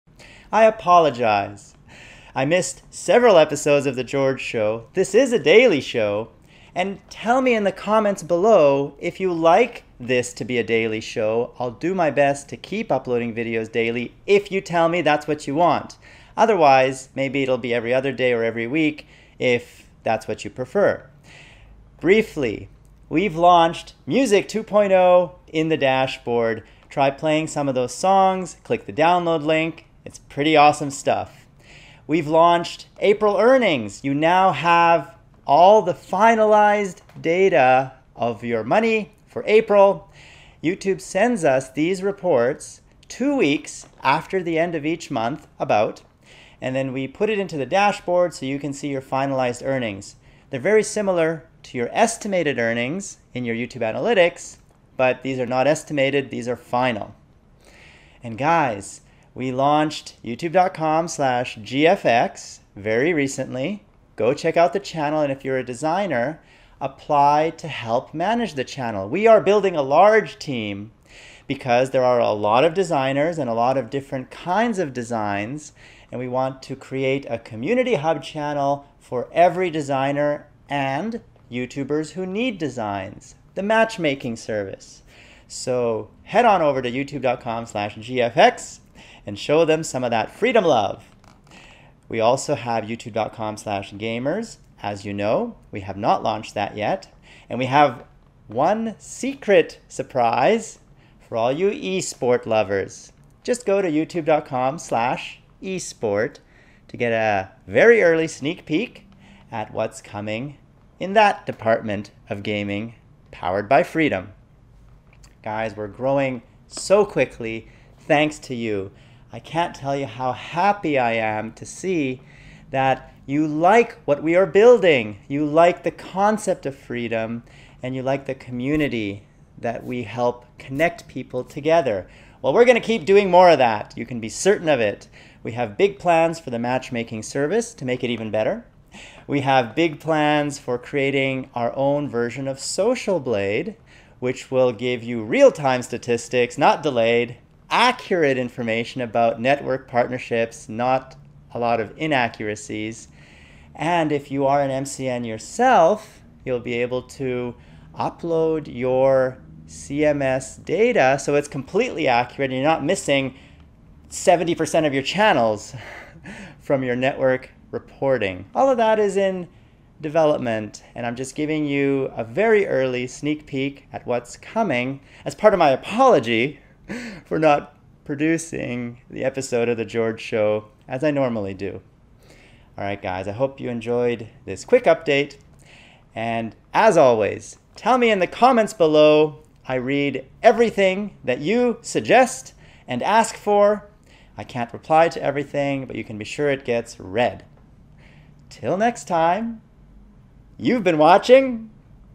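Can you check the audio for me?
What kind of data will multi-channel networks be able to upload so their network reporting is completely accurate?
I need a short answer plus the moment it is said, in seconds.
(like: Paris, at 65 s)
CMS data, at 159 s.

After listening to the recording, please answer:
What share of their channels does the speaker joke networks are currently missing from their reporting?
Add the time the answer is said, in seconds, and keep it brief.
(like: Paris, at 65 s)
70%, at 164 s.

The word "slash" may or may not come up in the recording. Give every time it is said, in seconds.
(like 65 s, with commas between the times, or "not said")
61 s, 87 s, 93 s, 104 s.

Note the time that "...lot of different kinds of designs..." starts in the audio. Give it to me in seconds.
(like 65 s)
73 s.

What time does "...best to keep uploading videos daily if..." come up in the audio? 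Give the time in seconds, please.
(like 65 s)
12 s.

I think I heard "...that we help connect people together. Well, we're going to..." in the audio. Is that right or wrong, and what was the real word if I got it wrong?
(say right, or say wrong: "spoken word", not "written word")
right.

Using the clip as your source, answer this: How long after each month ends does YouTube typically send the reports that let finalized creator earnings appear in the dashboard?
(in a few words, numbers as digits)
2 weeks.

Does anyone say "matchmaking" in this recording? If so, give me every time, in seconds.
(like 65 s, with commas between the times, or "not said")
83 s, 136 s.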